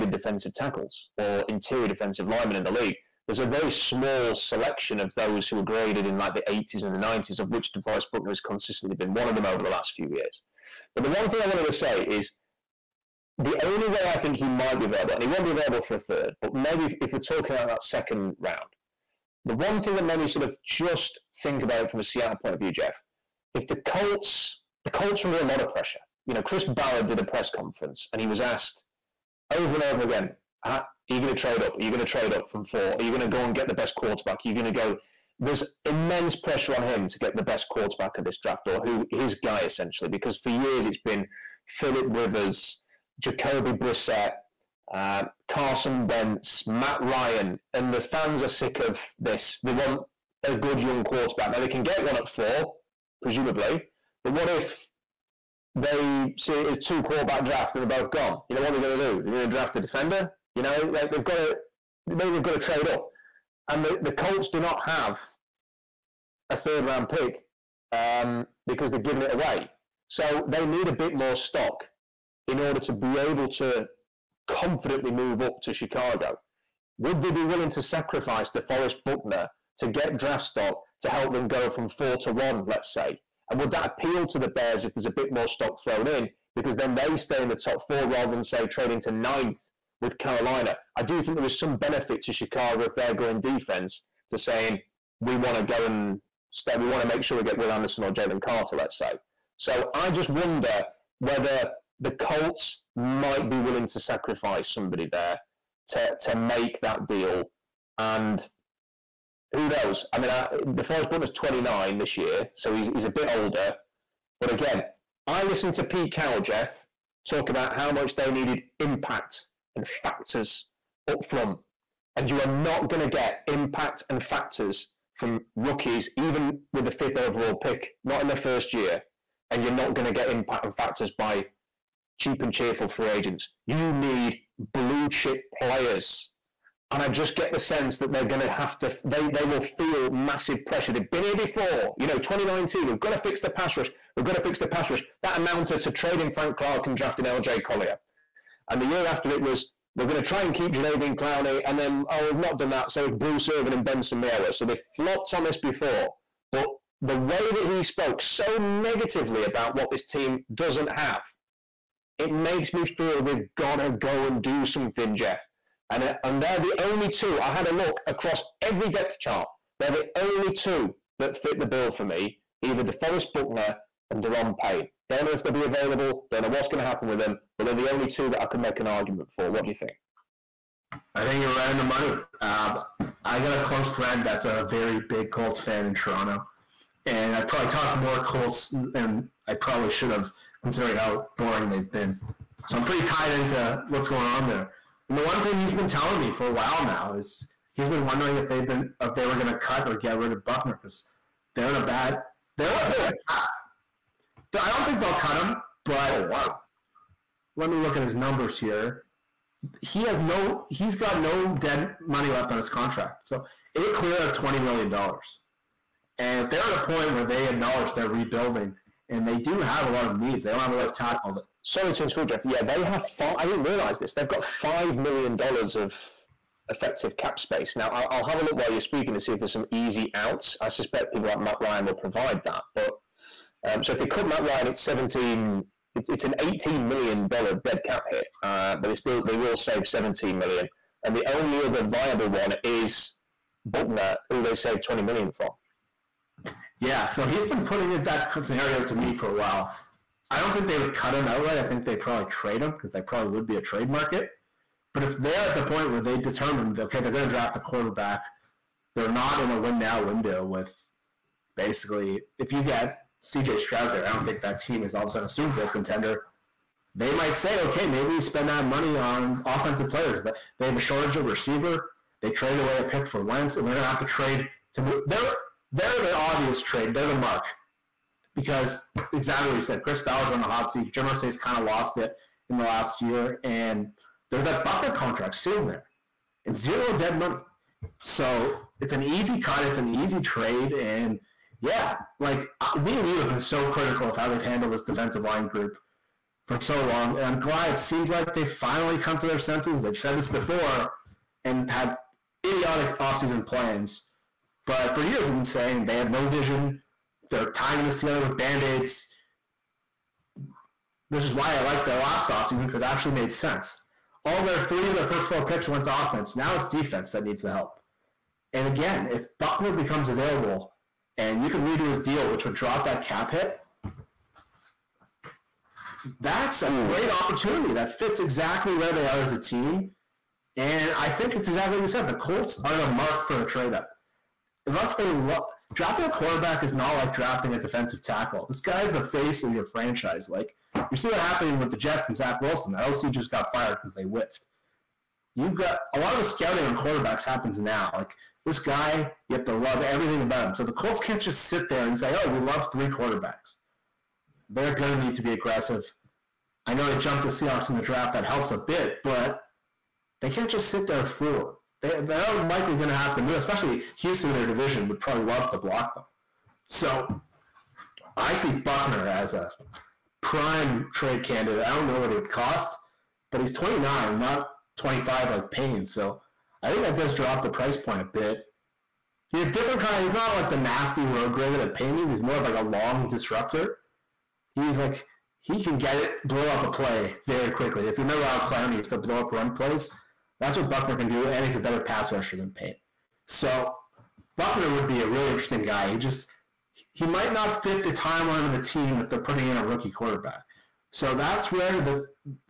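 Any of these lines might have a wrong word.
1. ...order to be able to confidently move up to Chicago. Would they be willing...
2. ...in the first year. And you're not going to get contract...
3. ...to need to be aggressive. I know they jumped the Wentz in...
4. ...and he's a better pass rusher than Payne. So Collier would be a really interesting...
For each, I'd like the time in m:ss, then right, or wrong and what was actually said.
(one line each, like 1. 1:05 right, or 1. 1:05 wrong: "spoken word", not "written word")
1. 1:12 right
2. 2:08 wrong: "impact", not "contract"
3. 5:54 wrong: "Seahawks", not "Wentz"
4. 6:31 wrong: "Buckner", not "Collier".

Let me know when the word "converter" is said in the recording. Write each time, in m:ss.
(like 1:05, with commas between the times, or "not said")
not said.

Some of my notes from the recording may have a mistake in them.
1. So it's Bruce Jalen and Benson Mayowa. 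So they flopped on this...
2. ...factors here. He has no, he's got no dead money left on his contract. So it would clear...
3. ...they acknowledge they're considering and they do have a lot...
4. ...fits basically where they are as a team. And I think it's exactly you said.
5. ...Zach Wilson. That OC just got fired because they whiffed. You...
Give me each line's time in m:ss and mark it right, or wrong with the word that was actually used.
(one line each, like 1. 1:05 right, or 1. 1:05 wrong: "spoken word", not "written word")
1. 2:32 wrong: "Irvin", not "Jalen"
2. 3:28 wrong: "numbers", not "factors"
3. 3:37 wrong: "rebuilding", not "considering"
4. 5:27 wrong: "exactly", not "basically"
5. 5:42 right.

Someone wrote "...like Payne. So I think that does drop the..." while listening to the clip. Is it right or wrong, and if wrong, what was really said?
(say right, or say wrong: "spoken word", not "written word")
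right.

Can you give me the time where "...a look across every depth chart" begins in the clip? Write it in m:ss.
2:47.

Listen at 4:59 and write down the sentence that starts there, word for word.
They've said this before and had idiotic offseason plans, but for years we've been saying they have no vision.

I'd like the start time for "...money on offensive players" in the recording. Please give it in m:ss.
4:28.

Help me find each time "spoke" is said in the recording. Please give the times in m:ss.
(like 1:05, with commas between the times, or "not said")
2:37.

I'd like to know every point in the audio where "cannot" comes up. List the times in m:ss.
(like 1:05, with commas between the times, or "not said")
not said.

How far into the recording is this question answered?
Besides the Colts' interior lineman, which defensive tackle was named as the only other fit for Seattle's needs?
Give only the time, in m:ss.
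2:54.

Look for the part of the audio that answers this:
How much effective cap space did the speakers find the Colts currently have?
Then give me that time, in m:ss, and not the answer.
3:44.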